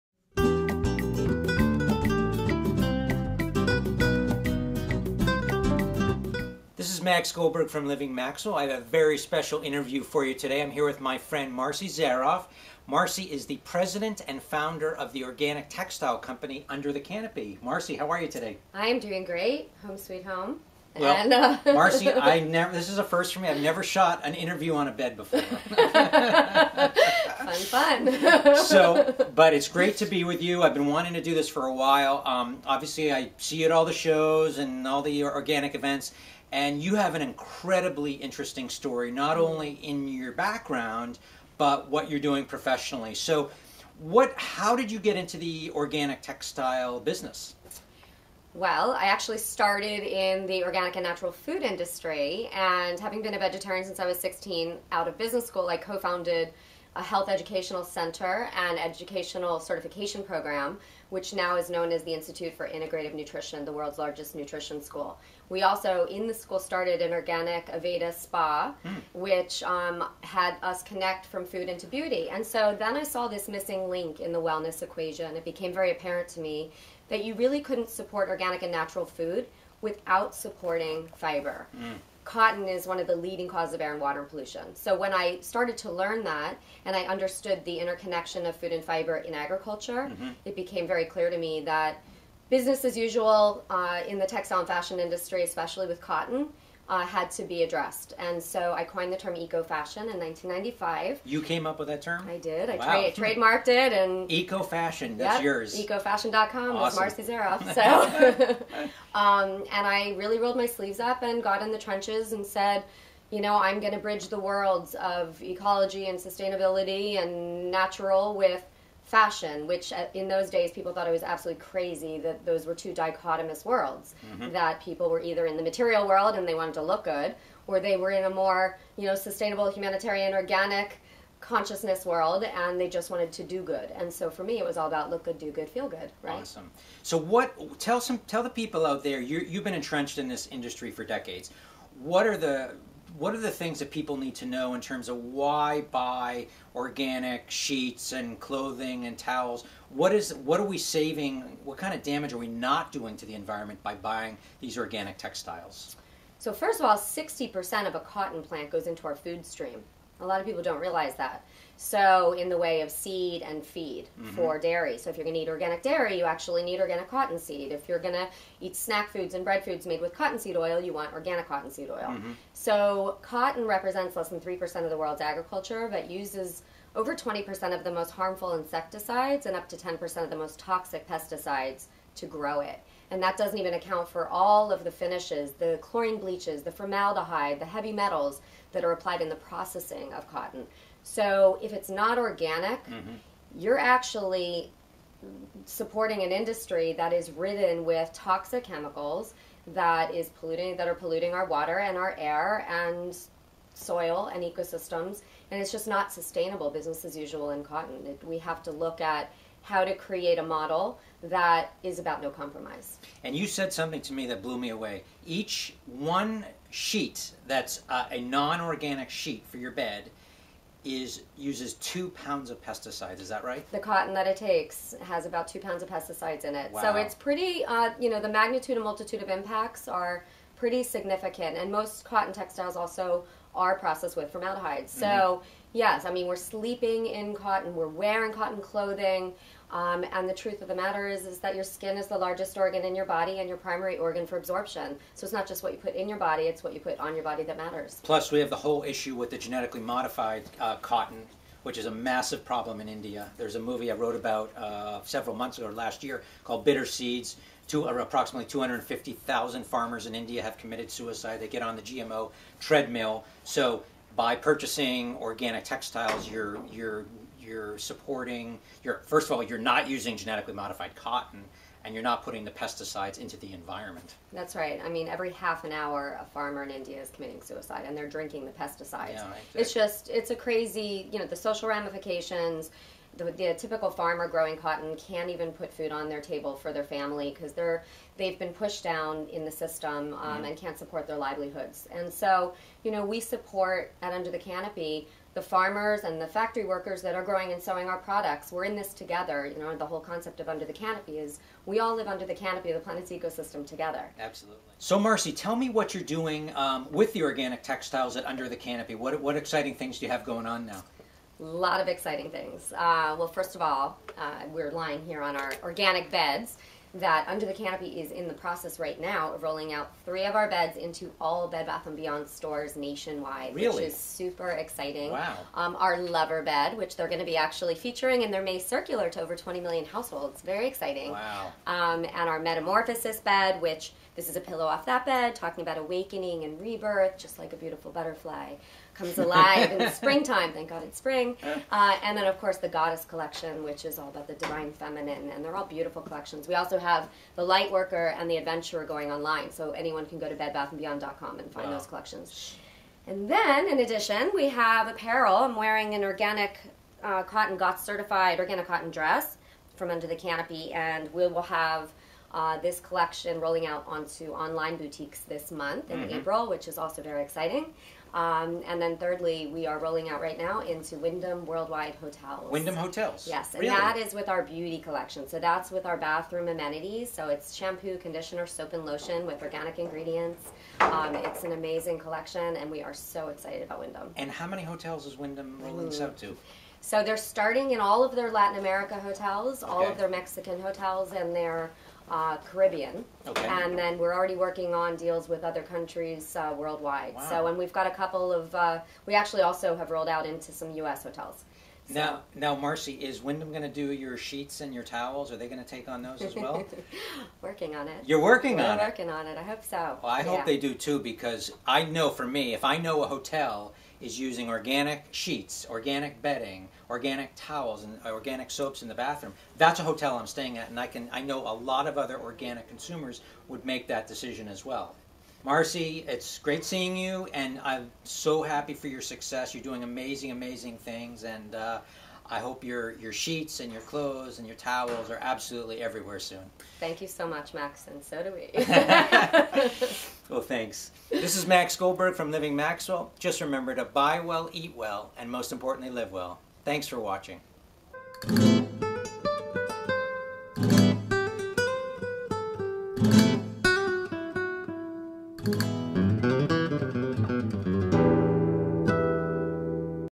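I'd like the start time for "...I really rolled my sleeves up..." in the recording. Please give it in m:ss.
1:49.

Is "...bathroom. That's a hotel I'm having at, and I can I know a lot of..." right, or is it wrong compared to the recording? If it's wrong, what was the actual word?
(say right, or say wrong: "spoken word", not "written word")
wrong: "staying", not "having".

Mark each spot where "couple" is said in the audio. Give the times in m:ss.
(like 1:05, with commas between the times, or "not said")
6:37.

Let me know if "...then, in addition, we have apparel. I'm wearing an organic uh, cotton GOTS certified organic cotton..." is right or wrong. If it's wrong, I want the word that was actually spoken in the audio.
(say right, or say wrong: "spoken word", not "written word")
right.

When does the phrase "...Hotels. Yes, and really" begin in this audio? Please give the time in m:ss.
6:12.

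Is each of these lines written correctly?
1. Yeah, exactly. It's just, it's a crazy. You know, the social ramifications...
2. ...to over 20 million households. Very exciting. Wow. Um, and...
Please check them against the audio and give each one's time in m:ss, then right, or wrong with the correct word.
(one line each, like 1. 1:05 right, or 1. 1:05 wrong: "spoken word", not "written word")
1. 4:39 right
2. 5:29 right.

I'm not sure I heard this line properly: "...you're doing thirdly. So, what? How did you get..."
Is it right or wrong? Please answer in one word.
wrong.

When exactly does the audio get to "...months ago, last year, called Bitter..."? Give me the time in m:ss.
4:15.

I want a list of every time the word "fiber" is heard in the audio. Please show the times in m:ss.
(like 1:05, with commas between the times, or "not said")
1:21, 1:28.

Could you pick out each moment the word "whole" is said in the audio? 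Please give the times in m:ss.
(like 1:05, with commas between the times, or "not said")
4:08, 4:59.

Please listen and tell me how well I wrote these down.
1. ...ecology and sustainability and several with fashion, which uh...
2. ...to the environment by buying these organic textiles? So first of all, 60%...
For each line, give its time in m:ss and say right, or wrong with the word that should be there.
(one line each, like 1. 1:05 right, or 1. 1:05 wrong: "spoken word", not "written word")
1. 1:55 wrong: "natural", not "several"
2. 2:33 right.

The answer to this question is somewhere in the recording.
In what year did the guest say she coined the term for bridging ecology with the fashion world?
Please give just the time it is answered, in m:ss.
1:40.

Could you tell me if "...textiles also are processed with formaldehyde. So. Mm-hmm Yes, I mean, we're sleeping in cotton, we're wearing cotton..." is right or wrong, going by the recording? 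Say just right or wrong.
right.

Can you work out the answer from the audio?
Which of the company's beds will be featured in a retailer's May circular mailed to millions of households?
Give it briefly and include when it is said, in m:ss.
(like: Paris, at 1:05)
Lover Bed, at 5:25.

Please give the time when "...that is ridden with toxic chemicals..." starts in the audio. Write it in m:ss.
3:16.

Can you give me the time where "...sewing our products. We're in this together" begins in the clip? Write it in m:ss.
4:57.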